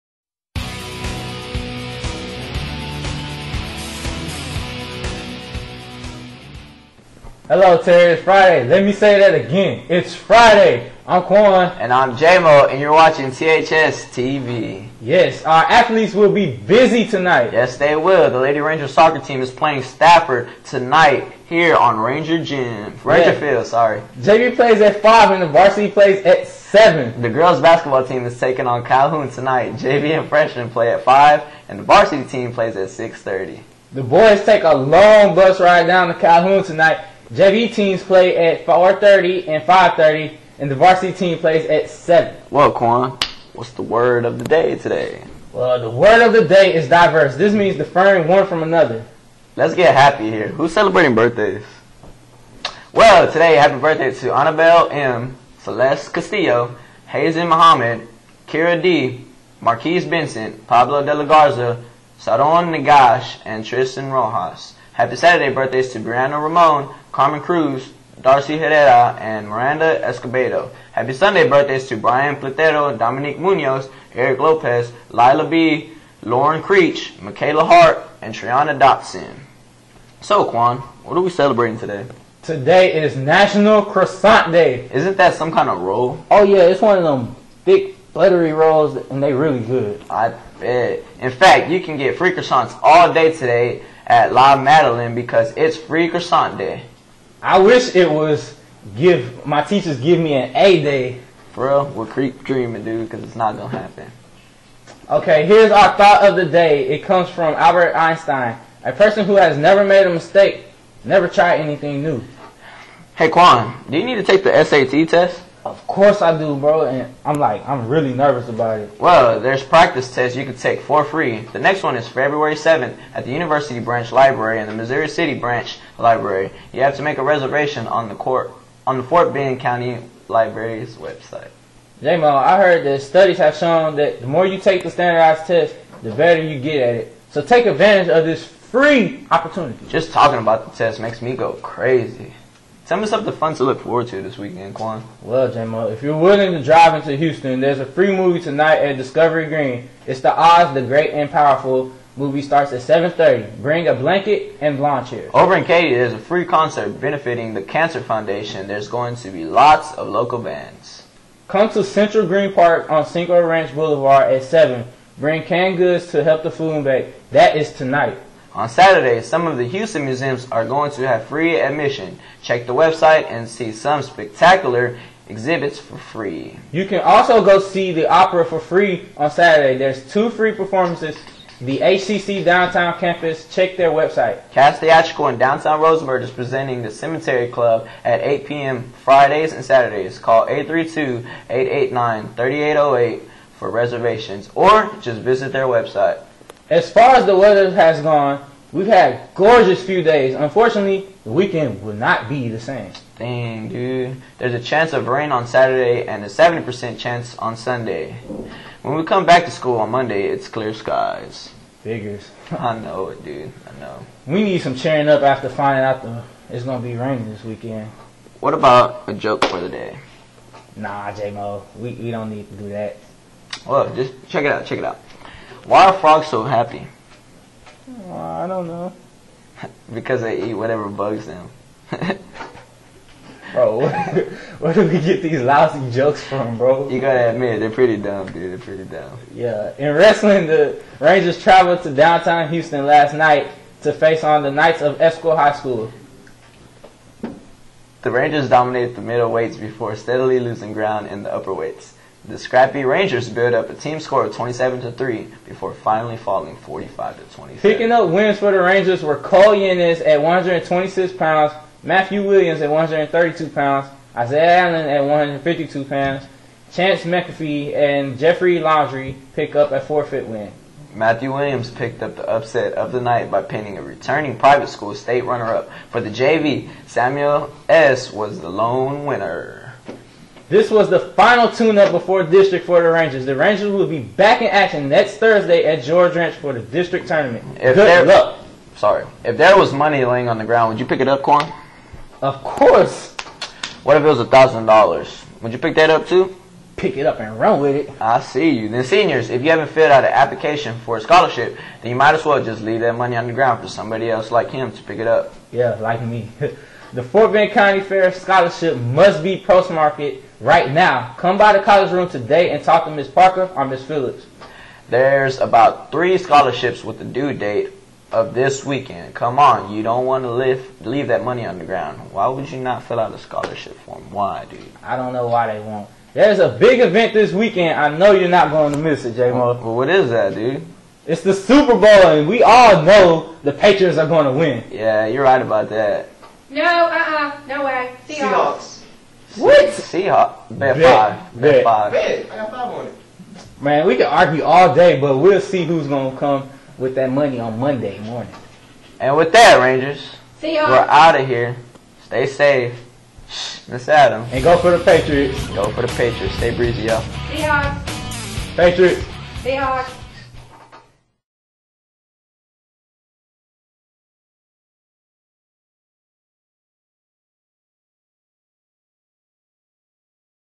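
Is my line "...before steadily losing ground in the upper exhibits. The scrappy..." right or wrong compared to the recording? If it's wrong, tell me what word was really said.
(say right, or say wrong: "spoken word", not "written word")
wrong: "weights", not "exhibits".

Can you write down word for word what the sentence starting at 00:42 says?
Well, Quan, what's the word of the day today?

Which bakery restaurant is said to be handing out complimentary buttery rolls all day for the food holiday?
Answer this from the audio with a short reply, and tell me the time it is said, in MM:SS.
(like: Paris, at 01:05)
La Madeleine, at 01:34.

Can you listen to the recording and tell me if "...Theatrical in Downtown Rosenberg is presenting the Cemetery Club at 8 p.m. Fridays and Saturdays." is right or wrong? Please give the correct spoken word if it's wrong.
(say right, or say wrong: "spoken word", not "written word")
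right.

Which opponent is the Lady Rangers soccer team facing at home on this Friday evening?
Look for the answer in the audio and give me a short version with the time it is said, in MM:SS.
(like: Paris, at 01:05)
Stafford, at 00:19.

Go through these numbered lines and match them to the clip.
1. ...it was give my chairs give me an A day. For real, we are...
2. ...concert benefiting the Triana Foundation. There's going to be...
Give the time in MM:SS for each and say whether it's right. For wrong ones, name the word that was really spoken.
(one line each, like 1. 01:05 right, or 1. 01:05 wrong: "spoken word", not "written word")
1. 01:37 wrong: "teachers", not "chairs"
2. 02:36 wrong: "Cancer", not "Triana".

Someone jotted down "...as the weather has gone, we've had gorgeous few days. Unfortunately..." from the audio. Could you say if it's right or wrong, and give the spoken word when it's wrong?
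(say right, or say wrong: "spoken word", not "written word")
right.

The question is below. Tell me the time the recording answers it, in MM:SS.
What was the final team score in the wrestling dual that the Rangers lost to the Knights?
04:16.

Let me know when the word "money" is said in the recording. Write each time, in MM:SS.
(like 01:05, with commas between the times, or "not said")
04:49, 05:02, 05:21, 05:47.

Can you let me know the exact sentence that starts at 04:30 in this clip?
Matthew Williams picked up the upset of the night by pinning a returning private school state runner-up.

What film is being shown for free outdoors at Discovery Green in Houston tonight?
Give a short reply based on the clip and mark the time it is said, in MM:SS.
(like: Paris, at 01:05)
Oz the Great and Powerful, at 02:30.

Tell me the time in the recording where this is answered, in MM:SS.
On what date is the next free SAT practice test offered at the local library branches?
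02:02.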